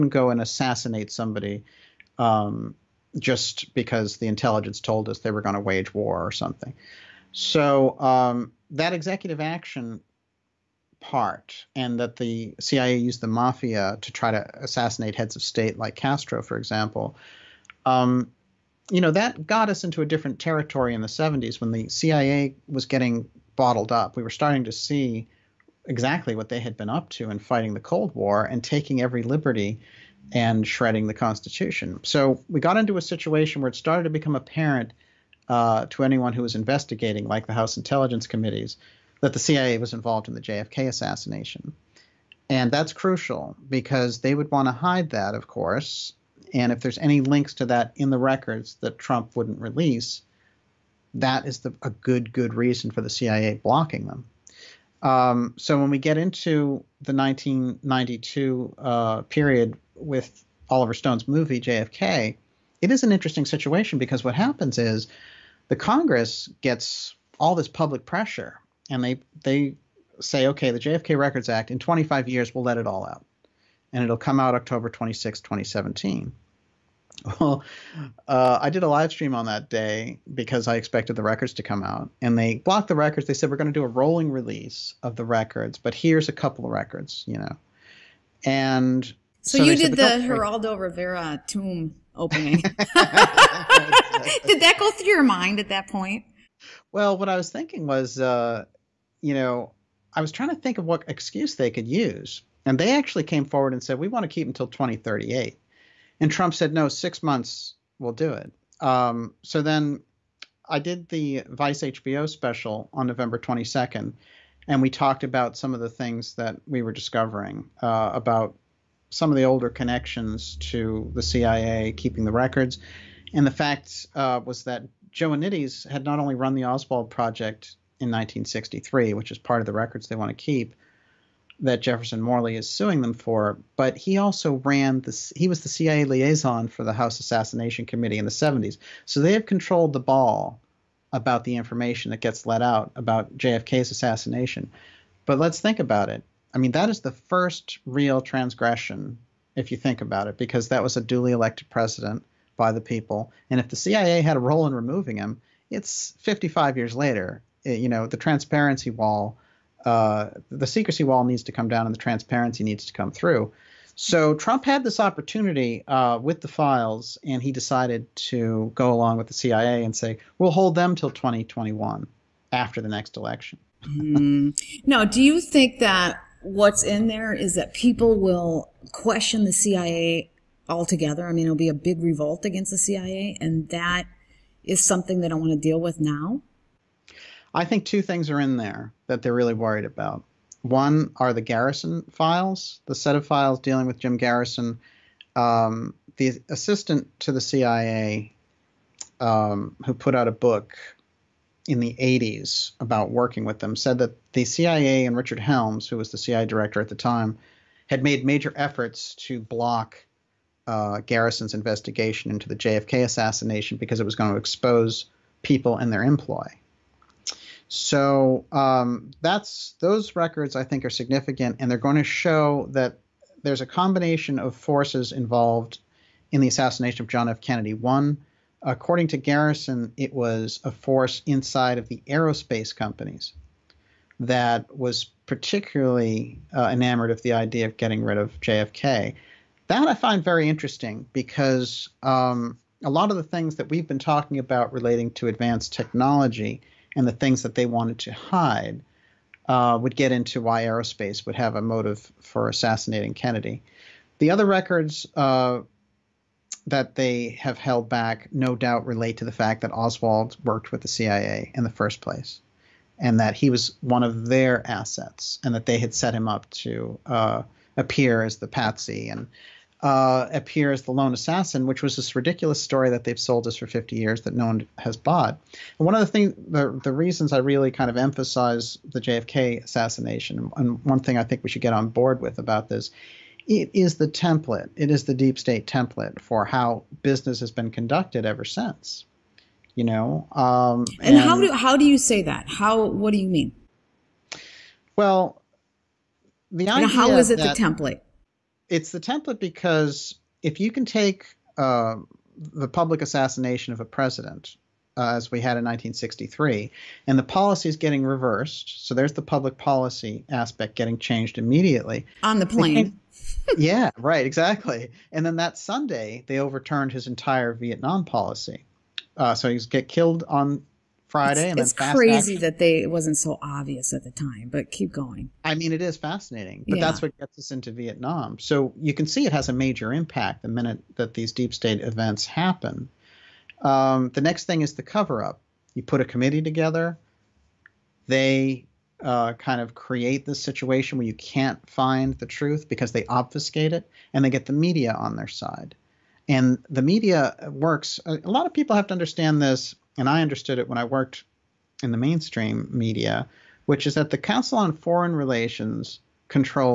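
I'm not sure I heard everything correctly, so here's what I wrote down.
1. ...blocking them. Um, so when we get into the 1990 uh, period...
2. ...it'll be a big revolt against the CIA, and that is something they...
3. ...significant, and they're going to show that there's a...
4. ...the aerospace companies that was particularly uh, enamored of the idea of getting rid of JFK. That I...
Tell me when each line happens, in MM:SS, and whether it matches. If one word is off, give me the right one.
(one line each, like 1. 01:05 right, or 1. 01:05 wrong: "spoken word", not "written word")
1. 00:53 wrong: "1992", not "1990"
2. 03:01 right
3. 03:40 right
4. 03:51 right.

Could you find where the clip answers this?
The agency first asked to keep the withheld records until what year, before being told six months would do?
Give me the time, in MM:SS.
01:44.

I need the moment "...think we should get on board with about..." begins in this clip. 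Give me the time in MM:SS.
04:41.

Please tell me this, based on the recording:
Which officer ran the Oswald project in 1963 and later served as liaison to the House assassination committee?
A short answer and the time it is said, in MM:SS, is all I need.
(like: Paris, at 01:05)
Joe Joannides, at 02:05.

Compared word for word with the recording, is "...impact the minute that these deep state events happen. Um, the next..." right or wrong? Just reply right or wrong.
right.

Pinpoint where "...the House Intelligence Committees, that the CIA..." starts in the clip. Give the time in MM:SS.
00:37.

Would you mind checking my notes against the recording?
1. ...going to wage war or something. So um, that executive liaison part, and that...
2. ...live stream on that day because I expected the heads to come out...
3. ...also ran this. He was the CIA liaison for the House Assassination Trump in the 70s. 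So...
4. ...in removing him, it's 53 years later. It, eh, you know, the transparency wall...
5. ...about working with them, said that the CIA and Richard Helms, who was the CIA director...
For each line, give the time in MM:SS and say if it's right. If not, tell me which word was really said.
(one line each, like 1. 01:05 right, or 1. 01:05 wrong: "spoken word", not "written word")
1. 00:05 wrong: "action", not "liaison"
2. 01:18 wrong: "records", not "heads"
3. 02:14 wrong: "Committee", not "Trump"
4. 02:34 wrong: "55", not "53"
5. 03:22 right.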